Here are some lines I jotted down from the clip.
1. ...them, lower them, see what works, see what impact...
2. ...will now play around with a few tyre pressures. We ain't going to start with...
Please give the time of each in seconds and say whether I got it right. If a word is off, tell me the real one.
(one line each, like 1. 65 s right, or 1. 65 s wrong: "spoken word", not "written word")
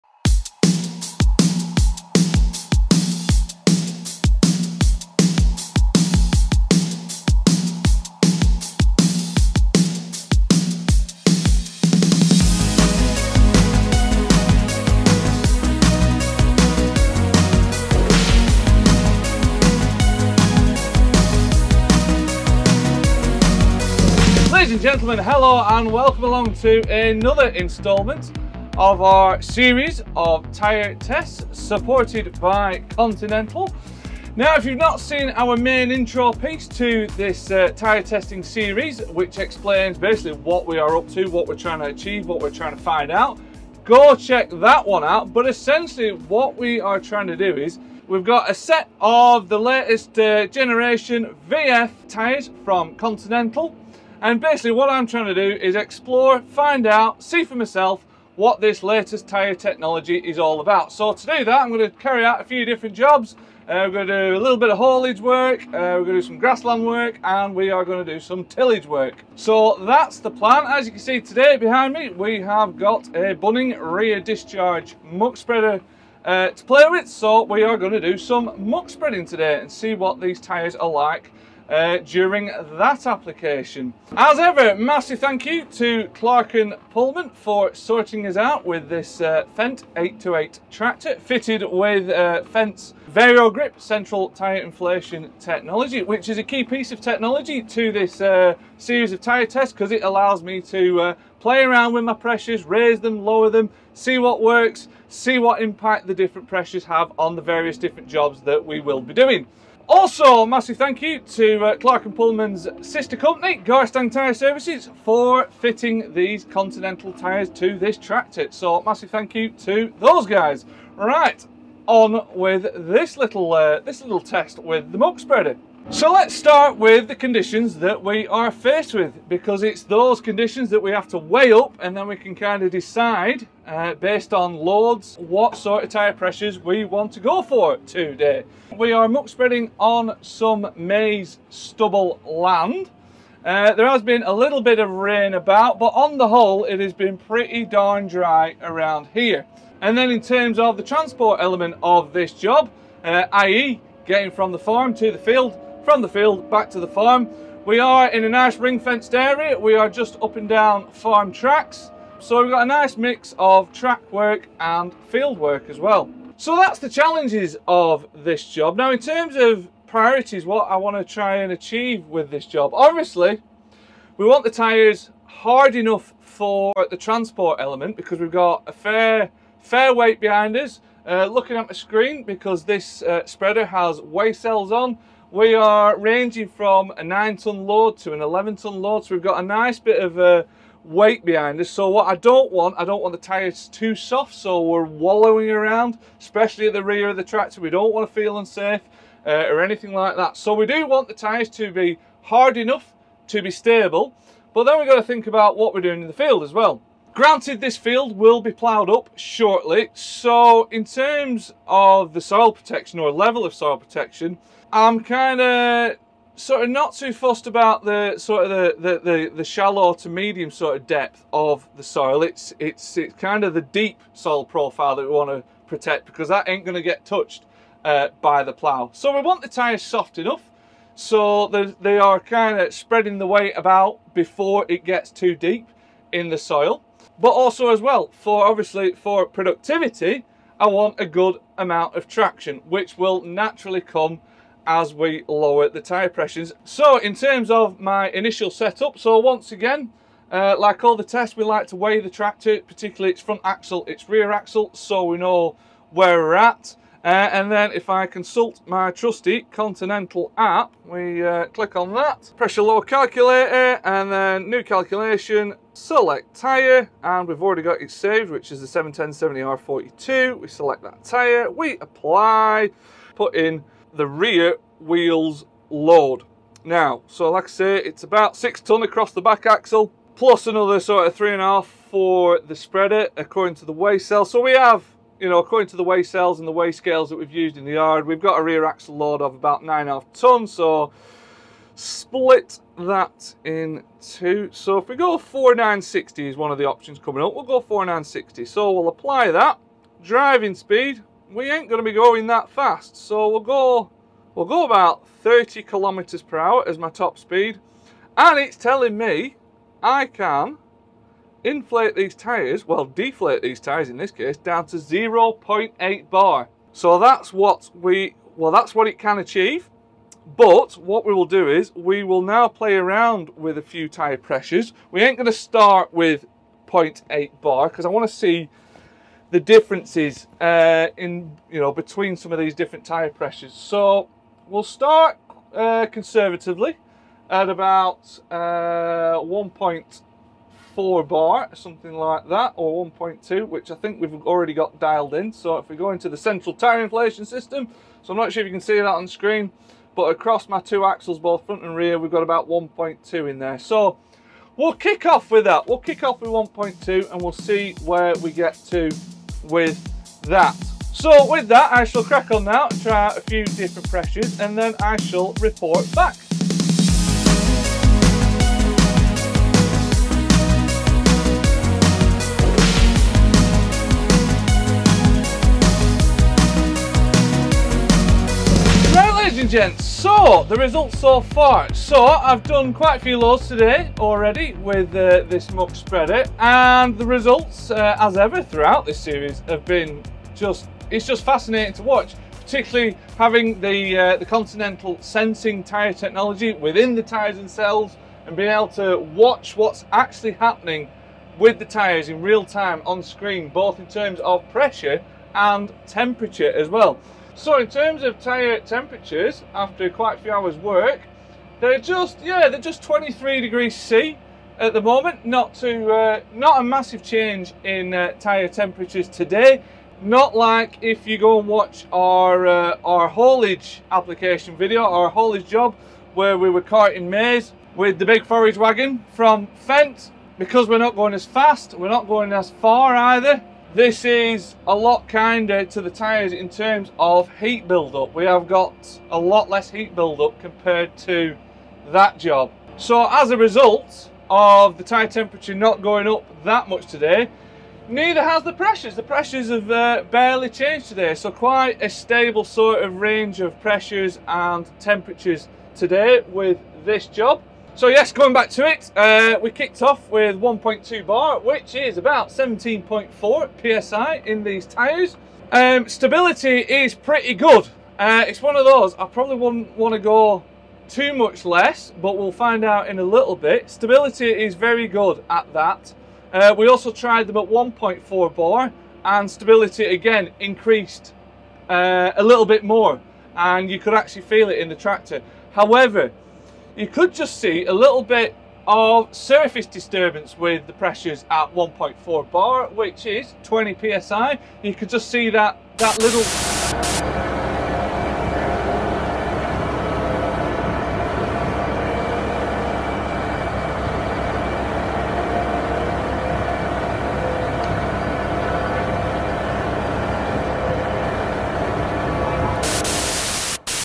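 1. 102 s right
2. 322 s right.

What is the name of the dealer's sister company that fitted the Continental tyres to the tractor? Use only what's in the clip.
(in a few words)
Garstang Tyre Services.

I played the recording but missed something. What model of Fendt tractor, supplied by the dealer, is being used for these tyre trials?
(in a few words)
Fendt 828.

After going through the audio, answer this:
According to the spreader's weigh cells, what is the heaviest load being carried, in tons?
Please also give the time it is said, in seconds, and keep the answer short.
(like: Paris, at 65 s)
11 ton, at 188 s.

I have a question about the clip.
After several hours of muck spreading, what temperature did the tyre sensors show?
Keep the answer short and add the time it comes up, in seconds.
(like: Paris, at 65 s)
23 degrees C, at 412 s.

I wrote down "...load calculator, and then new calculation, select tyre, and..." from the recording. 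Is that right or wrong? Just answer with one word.
right.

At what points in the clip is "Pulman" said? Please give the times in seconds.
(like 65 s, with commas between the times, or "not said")
86 s, 112 s.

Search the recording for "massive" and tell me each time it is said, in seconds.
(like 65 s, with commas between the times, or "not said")
84 s, 110 s, 118 s, 416 s.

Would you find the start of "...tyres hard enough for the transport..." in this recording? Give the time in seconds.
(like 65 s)
174 s.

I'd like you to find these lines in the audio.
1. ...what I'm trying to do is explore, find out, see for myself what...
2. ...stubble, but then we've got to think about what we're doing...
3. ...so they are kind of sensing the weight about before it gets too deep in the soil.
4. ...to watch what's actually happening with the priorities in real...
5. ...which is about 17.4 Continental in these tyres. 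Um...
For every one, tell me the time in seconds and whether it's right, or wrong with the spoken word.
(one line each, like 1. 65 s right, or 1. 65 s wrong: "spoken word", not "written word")
1. 54 s right
2. 203 s wrong: "stable", not "stubble"
3. 230 s wrong: "spreading", not "sensing"
4. 398 s wrong: "tyres", not "priorities"
5. 461 s wrong: "PSI", not "Continental".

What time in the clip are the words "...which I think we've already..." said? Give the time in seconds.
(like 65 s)
343 s.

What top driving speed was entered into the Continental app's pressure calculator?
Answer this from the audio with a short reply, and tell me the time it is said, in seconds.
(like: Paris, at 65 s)
30 km/h, at 305 s.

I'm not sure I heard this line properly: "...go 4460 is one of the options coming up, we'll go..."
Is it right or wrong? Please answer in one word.
wrong.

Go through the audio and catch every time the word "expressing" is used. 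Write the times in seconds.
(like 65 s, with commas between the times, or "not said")
not said.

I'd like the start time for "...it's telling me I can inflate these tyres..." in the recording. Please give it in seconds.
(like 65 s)
308 s.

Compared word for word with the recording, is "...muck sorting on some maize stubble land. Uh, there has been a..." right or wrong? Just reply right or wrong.
wrong.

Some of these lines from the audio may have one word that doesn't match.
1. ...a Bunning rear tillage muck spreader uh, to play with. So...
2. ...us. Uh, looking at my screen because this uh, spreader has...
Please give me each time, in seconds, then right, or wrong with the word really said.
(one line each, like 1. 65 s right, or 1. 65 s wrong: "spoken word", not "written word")
1. 73 s wrong: "discharge", not "tillage"
2. 180 s right.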